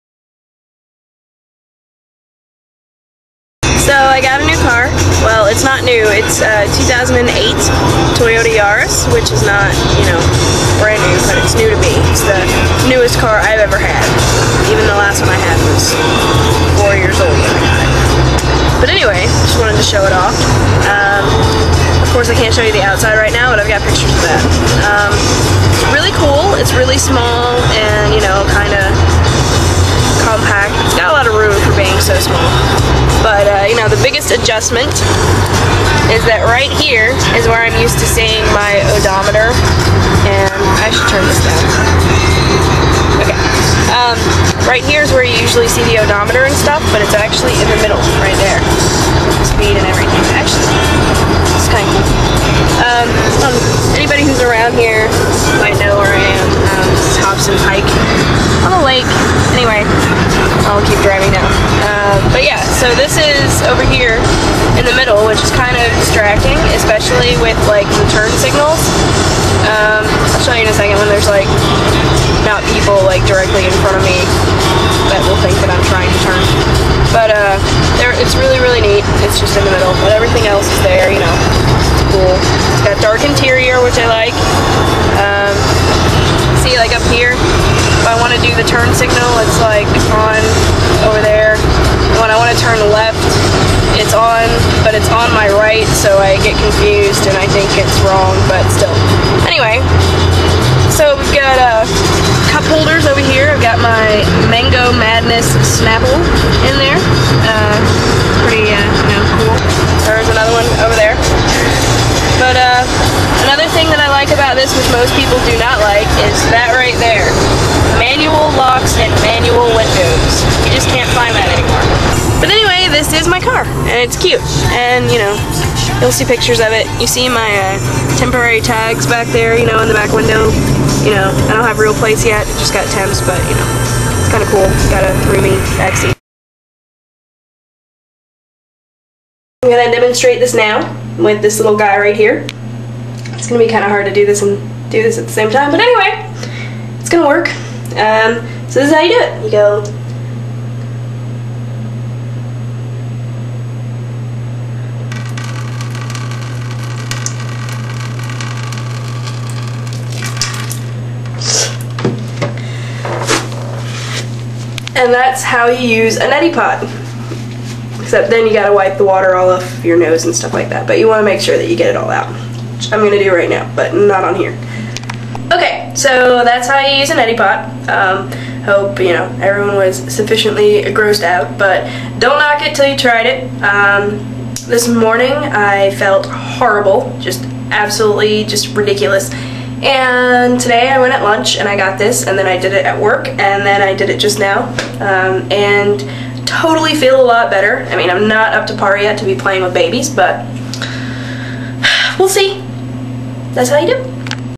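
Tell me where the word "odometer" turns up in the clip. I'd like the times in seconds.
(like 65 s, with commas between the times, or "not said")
38 s, 46 s.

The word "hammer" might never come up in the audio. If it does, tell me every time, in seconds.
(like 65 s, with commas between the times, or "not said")
not said.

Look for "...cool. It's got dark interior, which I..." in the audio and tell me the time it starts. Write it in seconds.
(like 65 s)
82 s.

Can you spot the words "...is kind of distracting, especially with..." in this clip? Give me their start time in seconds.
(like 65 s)
65 s.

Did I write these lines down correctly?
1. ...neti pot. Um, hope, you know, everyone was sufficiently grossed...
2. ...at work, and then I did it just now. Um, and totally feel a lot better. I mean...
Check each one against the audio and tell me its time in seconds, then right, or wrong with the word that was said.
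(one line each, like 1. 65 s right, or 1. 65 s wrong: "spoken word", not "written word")
1. 177 s right
2. 192 s right.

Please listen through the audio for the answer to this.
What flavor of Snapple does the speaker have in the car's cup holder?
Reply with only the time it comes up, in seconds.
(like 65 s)
104 s.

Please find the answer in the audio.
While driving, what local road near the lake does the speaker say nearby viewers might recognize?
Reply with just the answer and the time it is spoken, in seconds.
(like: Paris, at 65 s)
Hobson Pike, at 57 s.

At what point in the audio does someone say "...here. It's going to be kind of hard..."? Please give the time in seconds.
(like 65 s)
142 s.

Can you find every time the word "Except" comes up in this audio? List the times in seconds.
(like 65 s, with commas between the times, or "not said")
167 s.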